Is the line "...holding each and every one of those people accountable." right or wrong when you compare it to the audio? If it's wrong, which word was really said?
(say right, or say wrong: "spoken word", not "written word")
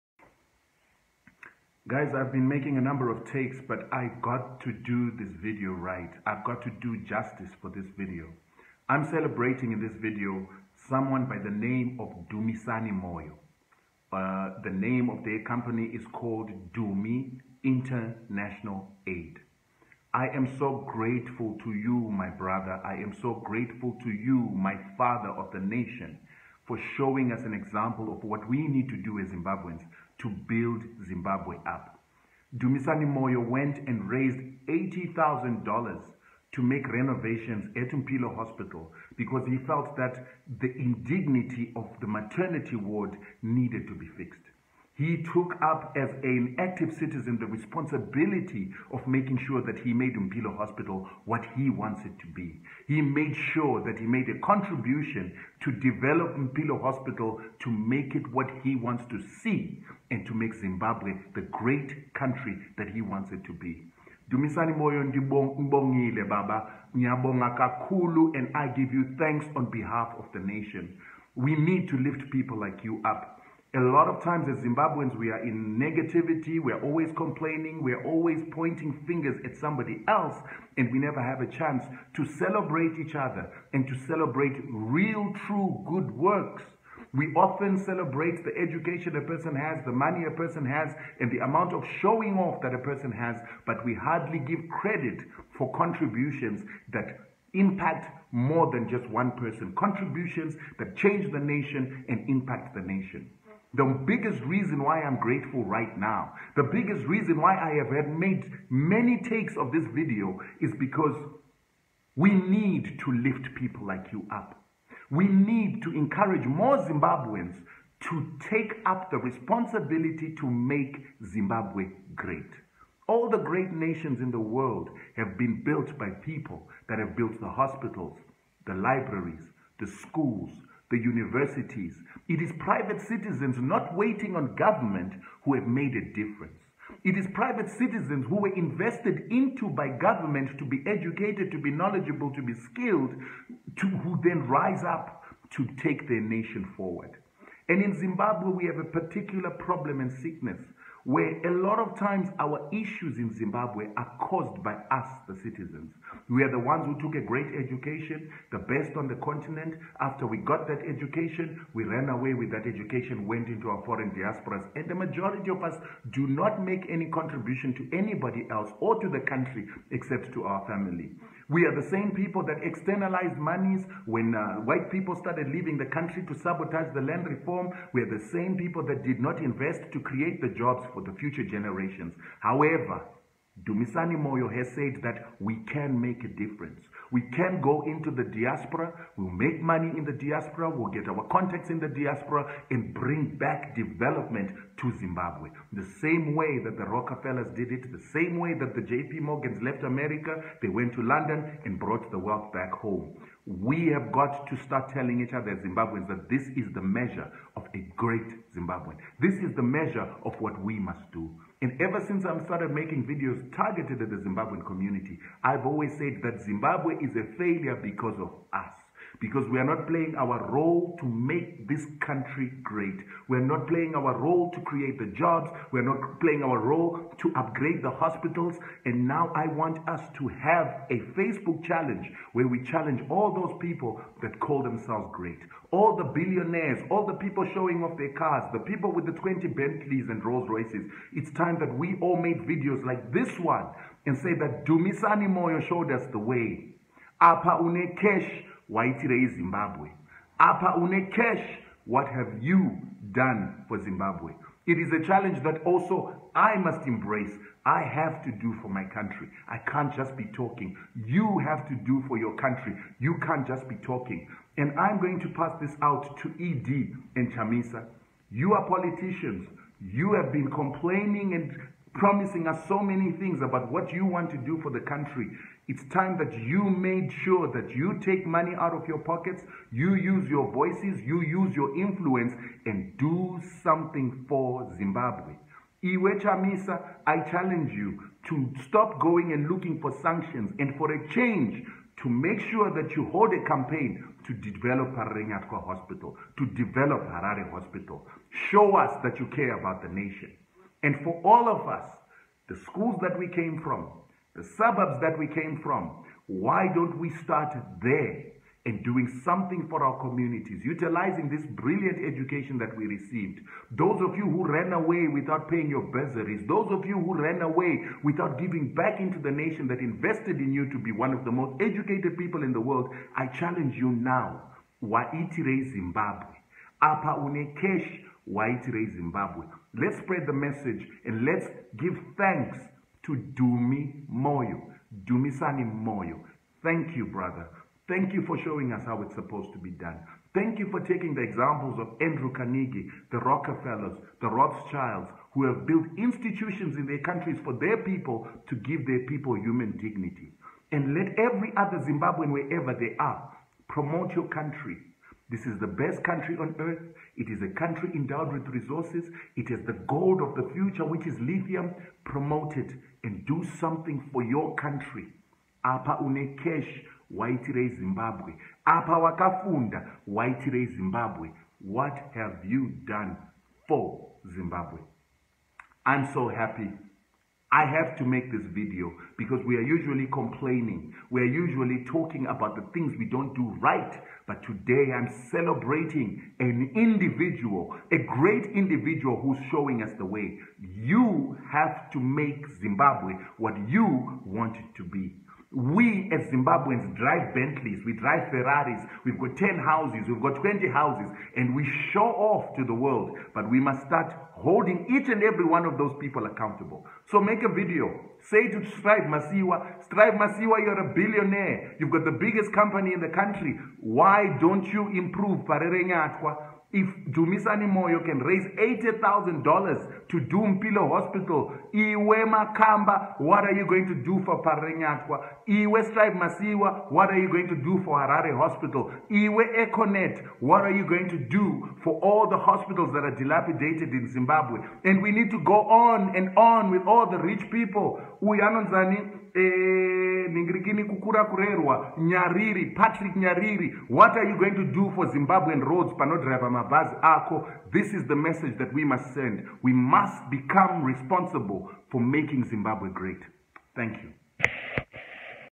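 right.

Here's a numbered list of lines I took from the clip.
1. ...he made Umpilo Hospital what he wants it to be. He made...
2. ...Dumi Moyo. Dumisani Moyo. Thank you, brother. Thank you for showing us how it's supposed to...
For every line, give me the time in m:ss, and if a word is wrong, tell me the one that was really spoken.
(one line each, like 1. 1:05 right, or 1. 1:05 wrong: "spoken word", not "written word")
1. 0:49 right
2. 5:33 right.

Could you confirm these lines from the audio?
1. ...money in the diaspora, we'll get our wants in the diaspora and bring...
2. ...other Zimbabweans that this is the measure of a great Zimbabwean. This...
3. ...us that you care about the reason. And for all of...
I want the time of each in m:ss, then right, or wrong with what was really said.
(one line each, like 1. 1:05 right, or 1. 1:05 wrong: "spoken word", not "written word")
1. 3:09 wrong: "contacts", not "wants"
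2. 3:25 right
3. 4:58 wrong: "nation", not "reason".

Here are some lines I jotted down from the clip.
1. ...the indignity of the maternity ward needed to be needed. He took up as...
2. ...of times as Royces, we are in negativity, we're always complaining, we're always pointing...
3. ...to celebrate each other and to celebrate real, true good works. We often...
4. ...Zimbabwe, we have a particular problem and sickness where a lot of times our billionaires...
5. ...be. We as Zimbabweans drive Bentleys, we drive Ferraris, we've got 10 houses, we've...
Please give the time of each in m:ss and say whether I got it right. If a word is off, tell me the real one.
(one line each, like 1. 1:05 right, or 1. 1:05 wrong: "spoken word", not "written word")
1. 0:40 wrong: "fixed", not "needed"
2. 1:14 wrong: "Zimbabweans", not "Royces"
3. 1:22 right
4. 2:27 wrong: "issues", not "billionaires"
5. 6:34 right.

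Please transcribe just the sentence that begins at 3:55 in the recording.
All the billionaires, all the people showing off their cars, the people with the 20 Bentleys and Rolls Royces.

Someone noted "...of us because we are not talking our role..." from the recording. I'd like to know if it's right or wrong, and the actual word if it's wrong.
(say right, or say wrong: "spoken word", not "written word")
wrong: "playing", not "talking".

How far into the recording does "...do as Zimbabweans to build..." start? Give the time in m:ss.
0:29.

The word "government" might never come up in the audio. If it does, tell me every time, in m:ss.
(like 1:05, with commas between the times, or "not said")
2:14, 2:19.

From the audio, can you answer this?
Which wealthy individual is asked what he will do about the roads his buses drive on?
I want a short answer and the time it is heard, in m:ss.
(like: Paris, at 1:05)
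Patrick Nyariri, at 7:22.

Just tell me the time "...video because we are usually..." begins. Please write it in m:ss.
6:18.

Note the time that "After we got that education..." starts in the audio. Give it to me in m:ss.
2:39.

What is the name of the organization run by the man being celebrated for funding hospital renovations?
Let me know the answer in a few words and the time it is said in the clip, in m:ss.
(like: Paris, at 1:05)
Dumi International Aid, at 0:16.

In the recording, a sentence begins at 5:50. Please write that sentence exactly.
And let every other Zimbabwean, wherever they are, promote your country this is the best country on earth.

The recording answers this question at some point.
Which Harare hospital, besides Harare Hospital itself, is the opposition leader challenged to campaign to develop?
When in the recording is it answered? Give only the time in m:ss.
4:54.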